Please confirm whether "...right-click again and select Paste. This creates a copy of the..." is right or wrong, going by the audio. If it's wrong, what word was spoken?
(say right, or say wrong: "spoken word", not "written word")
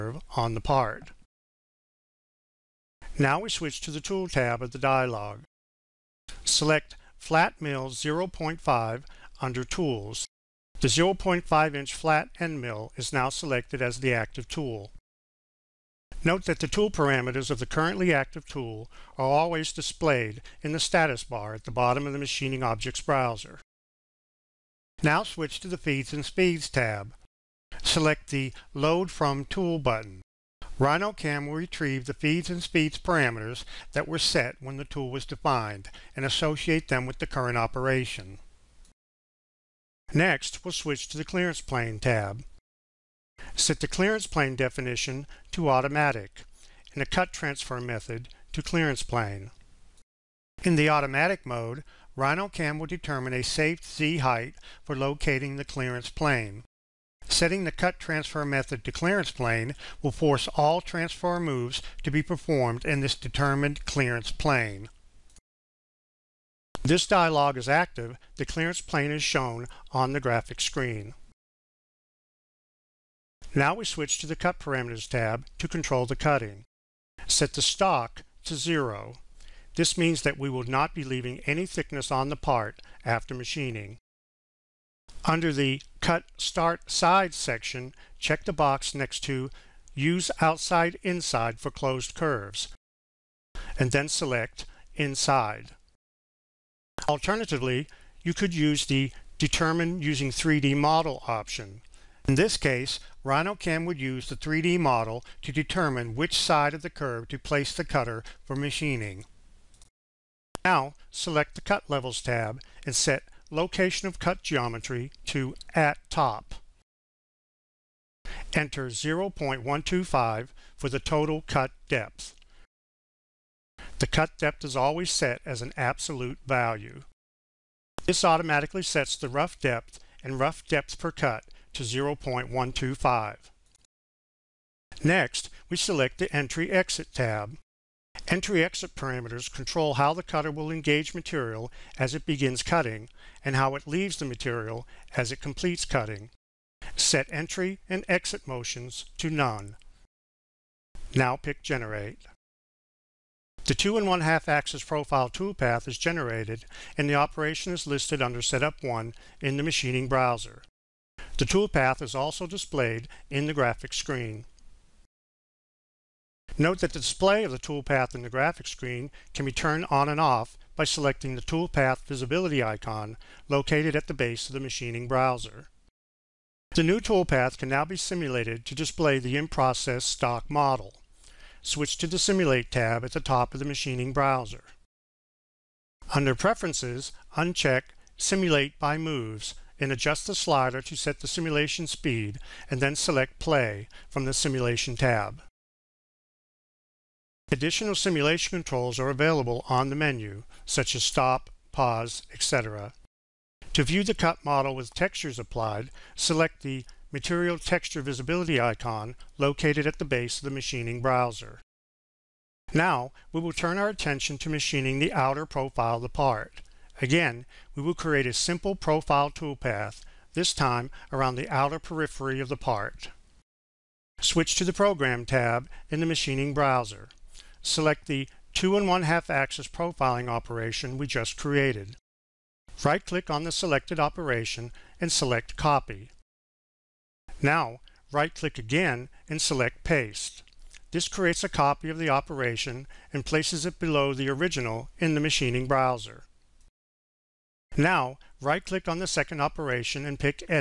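right.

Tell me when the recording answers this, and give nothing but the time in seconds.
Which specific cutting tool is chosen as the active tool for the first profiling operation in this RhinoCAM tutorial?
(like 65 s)
7 s.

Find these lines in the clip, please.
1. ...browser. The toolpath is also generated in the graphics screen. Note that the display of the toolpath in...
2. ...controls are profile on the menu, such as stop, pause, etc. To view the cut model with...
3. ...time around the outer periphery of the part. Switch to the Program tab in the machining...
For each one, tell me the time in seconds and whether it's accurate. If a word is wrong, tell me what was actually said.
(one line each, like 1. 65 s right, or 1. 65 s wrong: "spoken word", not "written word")
1. 160 s wrong: "displayed", not "generated"
2. 198 s wrong: "available", not "profile"
3. 220 s right.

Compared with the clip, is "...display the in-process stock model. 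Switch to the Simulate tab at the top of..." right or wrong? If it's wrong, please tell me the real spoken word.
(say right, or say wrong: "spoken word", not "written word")
right.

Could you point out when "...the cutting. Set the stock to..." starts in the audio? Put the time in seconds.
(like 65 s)
76 s.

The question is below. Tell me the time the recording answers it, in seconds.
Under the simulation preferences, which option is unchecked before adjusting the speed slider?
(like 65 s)
188 s.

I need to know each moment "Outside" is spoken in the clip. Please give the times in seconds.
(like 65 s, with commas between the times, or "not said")
90 s.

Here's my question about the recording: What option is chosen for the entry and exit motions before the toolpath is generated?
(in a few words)
none.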